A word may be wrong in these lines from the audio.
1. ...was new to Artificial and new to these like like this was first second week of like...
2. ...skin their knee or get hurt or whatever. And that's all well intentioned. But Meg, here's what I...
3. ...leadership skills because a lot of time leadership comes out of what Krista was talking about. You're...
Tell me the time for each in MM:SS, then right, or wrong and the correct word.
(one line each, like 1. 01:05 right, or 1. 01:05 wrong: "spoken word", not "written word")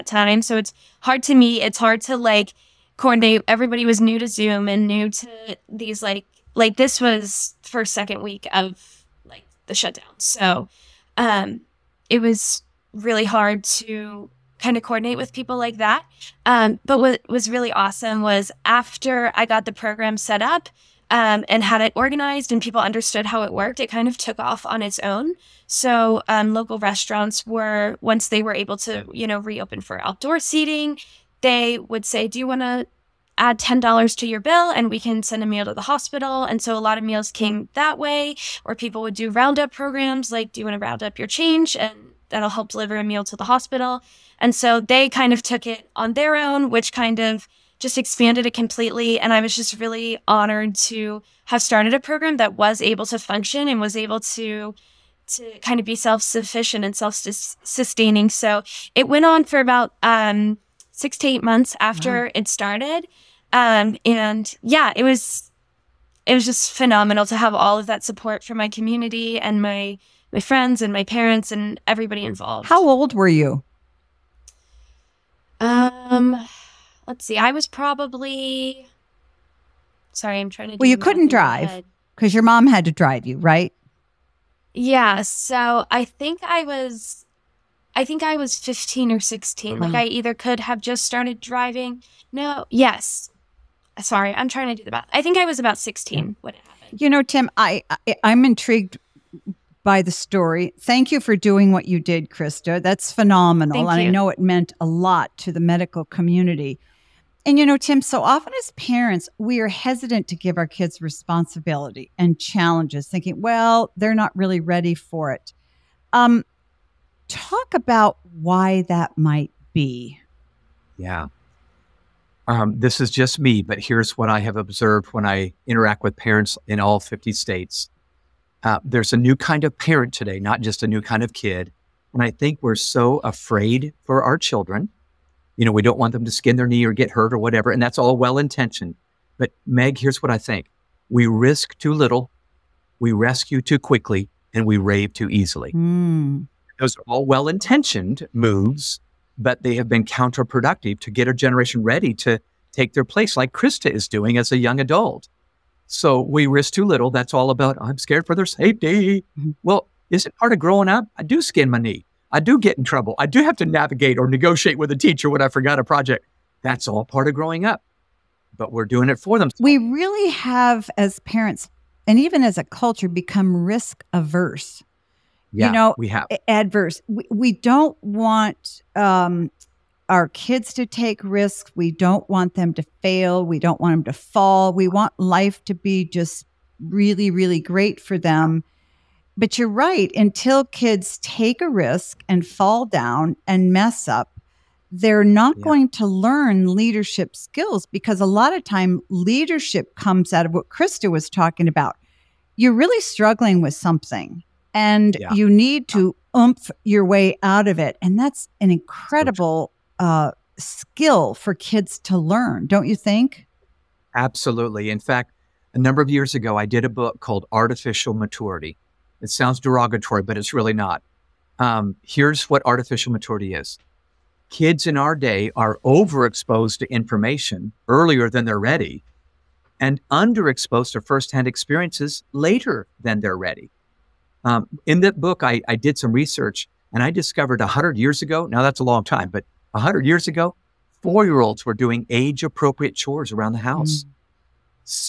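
1. 00:03 wrong: "Zoom", not "Artificial"
2. 02:16 right
3. 03:16 right.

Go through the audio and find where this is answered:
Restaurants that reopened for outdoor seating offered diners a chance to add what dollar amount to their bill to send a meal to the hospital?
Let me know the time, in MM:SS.
00:33.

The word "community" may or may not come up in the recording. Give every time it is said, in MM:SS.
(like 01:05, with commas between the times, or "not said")
01:08, 01:46.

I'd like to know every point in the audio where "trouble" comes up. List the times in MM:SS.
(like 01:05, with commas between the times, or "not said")
02:42.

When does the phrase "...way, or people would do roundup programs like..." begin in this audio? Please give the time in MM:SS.
00:37.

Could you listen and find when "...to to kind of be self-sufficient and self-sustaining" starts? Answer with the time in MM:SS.
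00:54.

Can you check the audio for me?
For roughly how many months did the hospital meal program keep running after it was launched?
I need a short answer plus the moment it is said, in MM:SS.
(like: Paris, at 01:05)
6 to 8 months, at 01:00.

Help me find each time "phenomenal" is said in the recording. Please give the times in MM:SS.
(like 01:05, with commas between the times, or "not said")
01:06, 01:43.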